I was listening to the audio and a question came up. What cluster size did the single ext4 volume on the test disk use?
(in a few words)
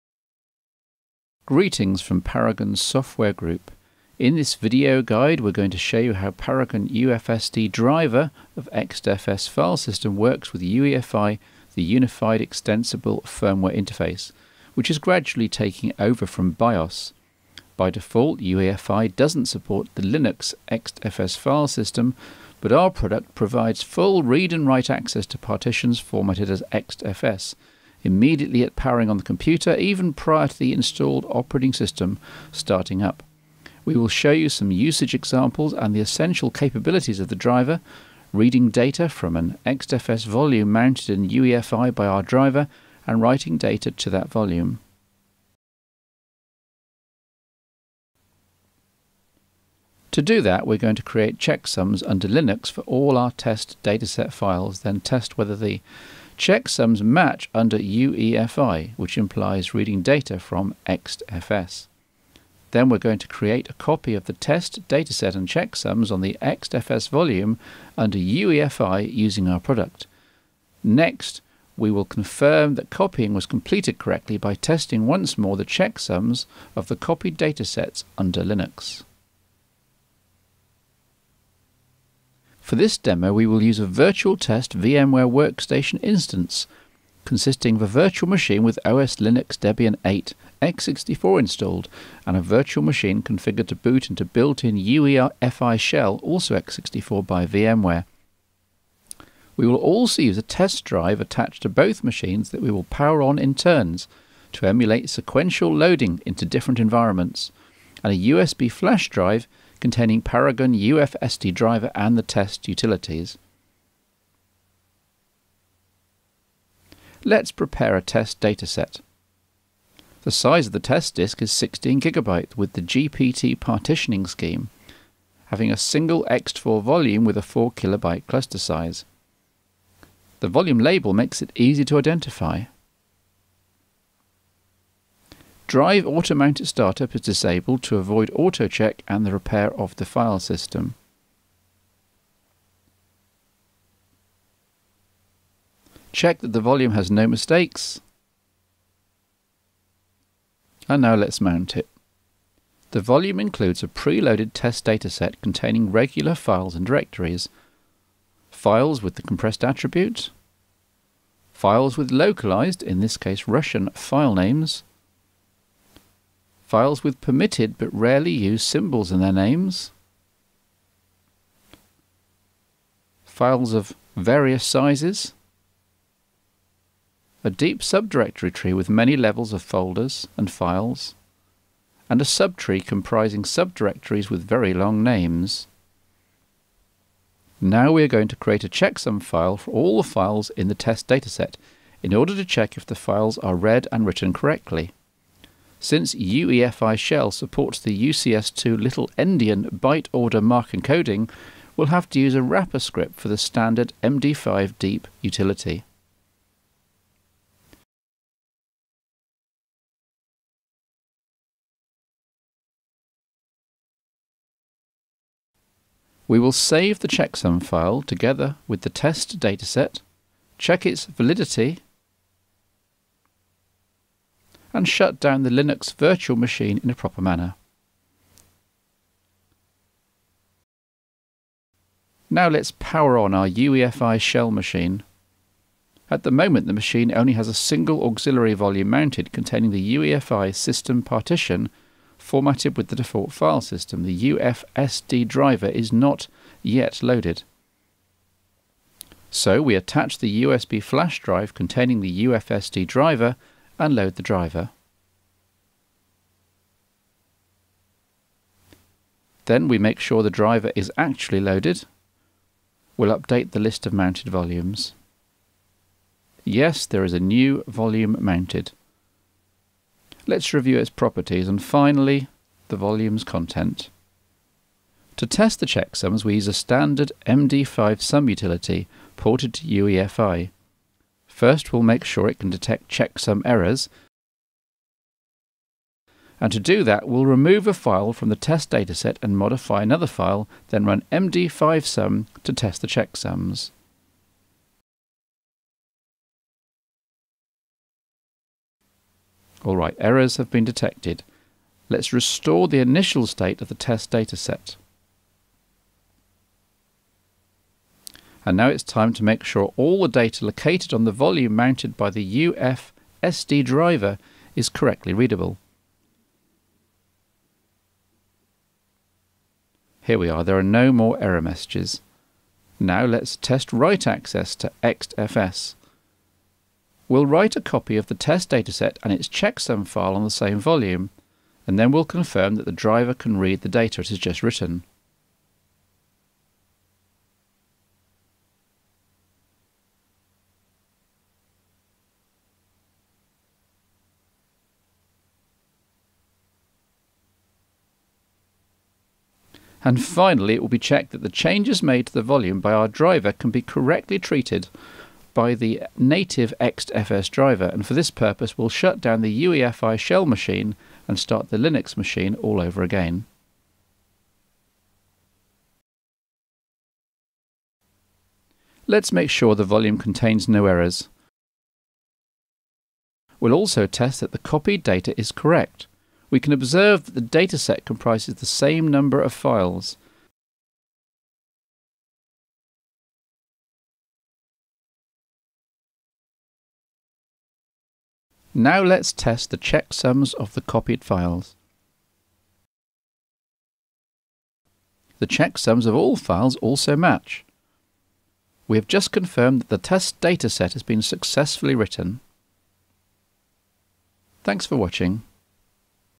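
4 kilobyte.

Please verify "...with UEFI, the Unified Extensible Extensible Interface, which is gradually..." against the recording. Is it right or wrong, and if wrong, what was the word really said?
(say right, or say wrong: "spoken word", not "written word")
wrong: "Firmware", not "Extensible".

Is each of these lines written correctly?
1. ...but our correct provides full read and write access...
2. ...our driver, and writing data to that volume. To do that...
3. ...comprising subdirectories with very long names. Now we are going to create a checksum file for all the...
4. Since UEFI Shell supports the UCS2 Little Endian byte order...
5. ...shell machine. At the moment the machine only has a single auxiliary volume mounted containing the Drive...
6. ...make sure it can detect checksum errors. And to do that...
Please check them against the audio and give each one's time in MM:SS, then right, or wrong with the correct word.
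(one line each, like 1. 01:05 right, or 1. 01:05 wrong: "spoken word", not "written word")
1. 00:22 wrong: "product", not "correct"
2. 00:42 right
3. 03:02 right
4. 03:15 right
5. 03:54 wrong: "UEFI", not "Drive"
6. 04:41 right.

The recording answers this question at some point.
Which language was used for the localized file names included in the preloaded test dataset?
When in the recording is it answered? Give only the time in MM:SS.
02:43.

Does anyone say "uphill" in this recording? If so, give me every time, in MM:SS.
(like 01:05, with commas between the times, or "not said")
not said.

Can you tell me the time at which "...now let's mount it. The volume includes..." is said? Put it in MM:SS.
02:31.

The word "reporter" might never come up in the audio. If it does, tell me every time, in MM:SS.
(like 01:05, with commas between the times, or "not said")
not said.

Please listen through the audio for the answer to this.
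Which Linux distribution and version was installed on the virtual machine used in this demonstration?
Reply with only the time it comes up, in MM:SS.
01:29.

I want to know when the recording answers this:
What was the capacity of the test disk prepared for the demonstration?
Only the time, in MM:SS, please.
02:01.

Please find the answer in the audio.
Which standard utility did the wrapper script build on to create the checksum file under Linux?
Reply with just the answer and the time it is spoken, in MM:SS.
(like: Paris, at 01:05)
md5deep, at 03:24.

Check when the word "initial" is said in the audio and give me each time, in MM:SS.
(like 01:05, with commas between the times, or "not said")
05:02.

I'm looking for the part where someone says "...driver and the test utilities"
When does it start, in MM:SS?
01:51.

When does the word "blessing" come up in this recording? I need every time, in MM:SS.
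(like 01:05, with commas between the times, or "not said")
not said.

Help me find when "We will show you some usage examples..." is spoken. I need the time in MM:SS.
00:33.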